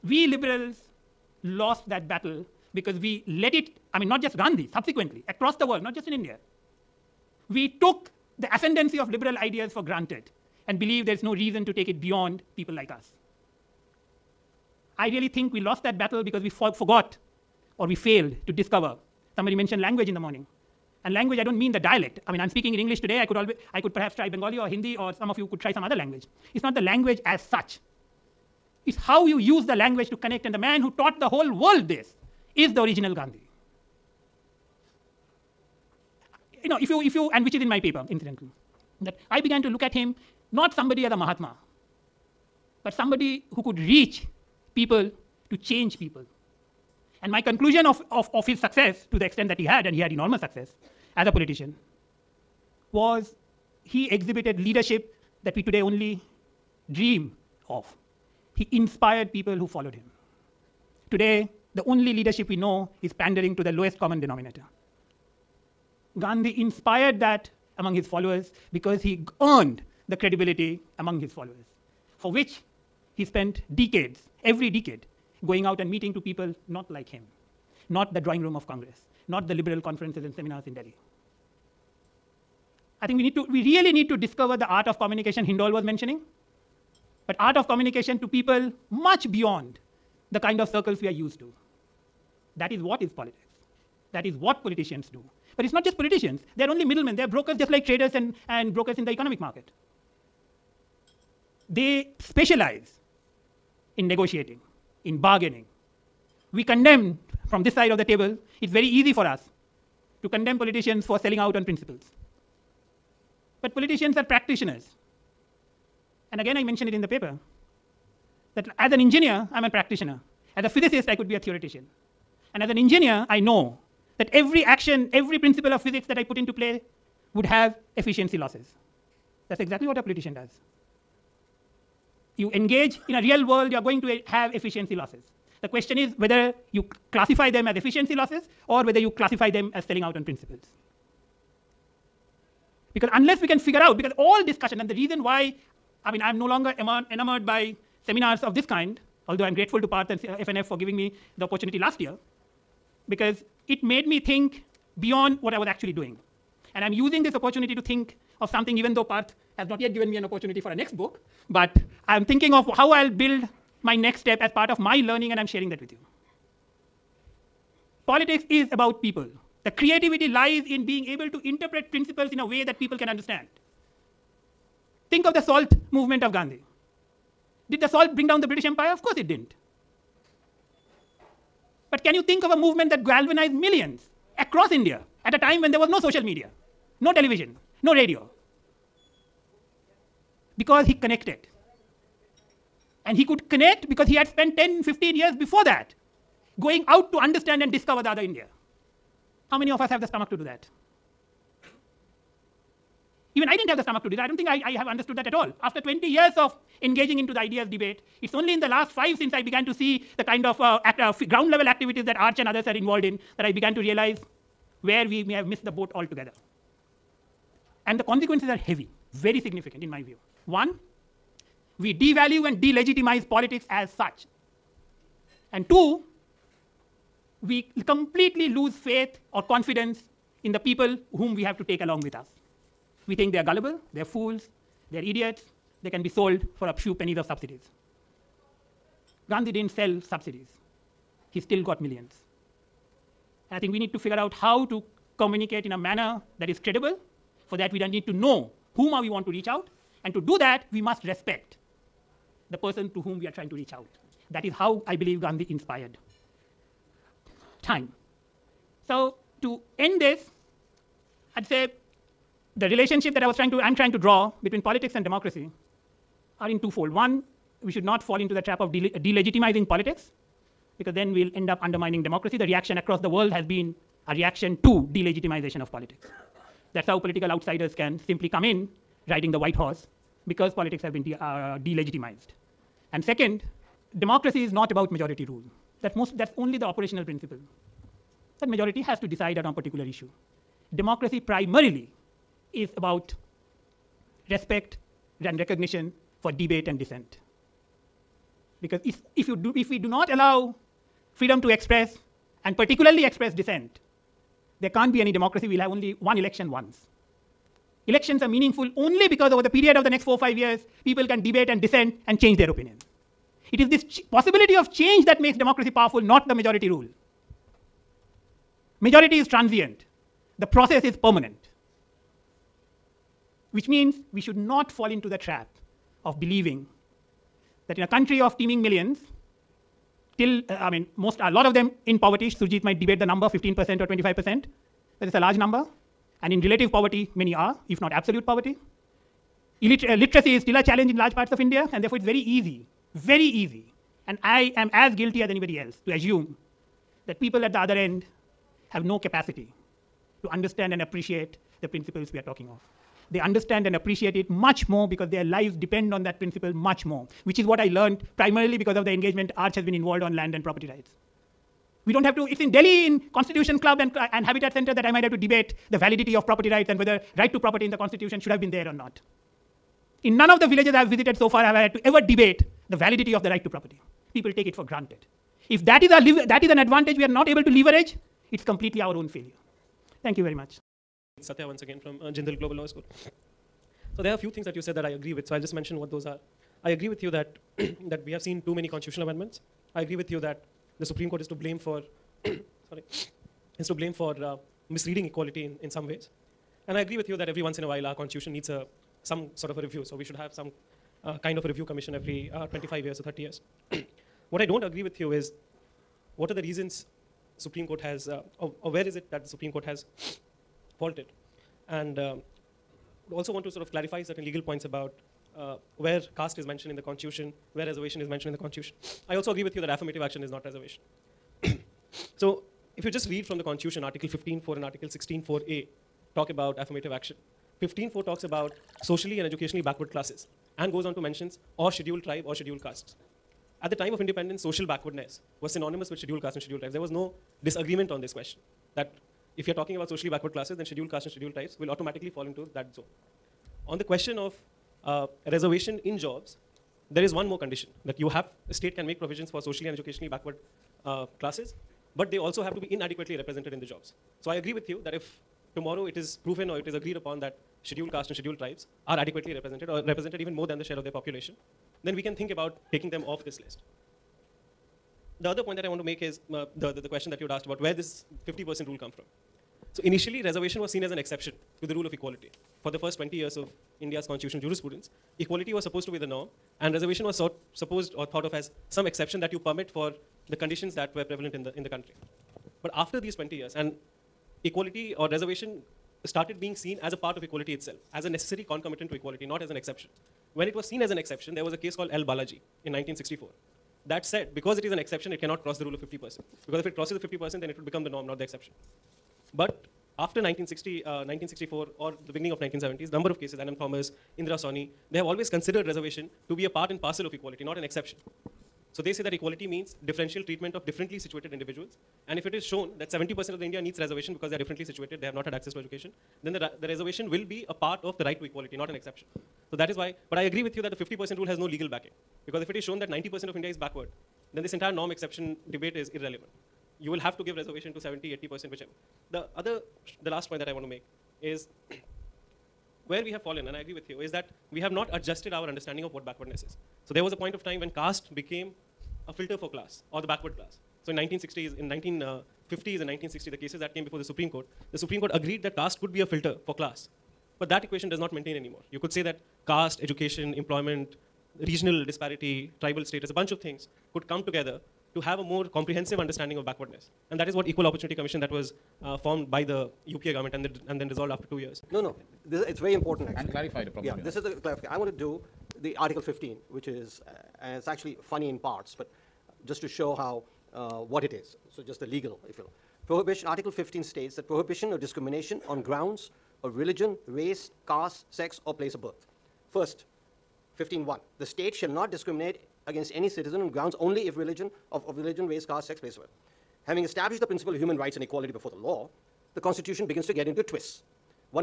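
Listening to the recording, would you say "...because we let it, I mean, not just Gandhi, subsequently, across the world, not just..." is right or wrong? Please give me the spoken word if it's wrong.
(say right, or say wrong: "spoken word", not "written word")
right.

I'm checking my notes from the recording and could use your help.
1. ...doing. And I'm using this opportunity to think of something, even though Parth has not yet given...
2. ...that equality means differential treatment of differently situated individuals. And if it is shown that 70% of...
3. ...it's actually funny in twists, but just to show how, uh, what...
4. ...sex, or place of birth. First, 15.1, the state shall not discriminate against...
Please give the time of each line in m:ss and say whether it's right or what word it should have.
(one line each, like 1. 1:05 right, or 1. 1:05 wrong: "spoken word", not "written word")
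1. 2:35 right
2. 8:29 right
3. 9:27 wrong: "parts", not "twists"
4. 9:38 right.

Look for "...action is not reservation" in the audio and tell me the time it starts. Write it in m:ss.
7:00.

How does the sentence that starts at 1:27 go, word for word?
But art of communication to people much beyond the kind of circles we are used to.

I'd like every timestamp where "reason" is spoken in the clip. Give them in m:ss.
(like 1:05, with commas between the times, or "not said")
0:11, 2:24, 6:46.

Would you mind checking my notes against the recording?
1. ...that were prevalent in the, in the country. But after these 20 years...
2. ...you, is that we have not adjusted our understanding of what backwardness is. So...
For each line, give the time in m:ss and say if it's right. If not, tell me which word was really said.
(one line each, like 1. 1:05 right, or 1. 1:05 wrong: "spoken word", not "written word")
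1. 8:00 right
2. 8:53 right.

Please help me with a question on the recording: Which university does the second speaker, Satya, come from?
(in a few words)
Jindal Global Law School.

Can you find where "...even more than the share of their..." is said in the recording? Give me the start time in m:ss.
7:40.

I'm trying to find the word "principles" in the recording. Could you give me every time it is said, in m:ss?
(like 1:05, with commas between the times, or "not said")
1:51, 2:05, 2:20, 2:51, 4:47, 5:51, 5:56, 9:47.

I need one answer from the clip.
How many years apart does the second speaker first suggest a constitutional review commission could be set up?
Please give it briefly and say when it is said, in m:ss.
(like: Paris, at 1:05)
25, at 6:42.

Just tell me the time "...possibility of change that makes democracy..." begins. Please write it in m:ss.
5:14.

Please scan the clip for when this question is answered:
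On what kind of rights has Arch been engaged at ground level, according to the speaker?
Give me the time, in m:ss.
6:00.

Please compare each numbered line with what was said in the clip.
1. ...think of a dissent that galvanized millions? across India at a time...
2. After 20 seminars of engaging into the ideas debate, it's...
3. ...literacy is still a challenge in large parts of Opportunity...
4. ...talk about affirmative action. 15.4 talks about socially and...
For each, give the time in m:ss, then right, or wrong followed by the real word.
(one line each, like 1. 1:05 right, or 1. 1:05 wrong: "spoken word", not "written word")
1. 3:02 wrong: "movement", not "dissent"
2. 3:25 wrong: "years", not "seminars"
3. 5:39 wrong: "India", not "Opportunity"
4. 7:06 right.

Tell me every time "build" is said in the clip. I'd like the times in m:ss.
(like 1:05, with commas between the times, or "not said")
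2:43.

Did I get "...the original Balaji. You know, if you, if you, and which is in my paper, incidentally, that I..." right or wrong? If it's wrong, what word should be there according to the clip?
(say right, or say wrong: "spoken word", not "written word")
wrong: "Gandhi", not "Balaji".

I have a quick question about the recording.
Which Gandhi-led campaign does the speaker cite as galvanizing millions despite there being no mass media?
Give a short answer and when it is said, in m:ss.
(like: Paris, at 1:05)
salt movement, at 2:55.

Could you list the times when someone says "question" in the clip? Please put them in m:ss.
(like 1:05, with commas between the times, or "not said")
2:15, 7:18, 7:23, 7:46.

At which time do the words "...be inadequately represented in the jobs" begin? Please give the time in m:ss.
7:32.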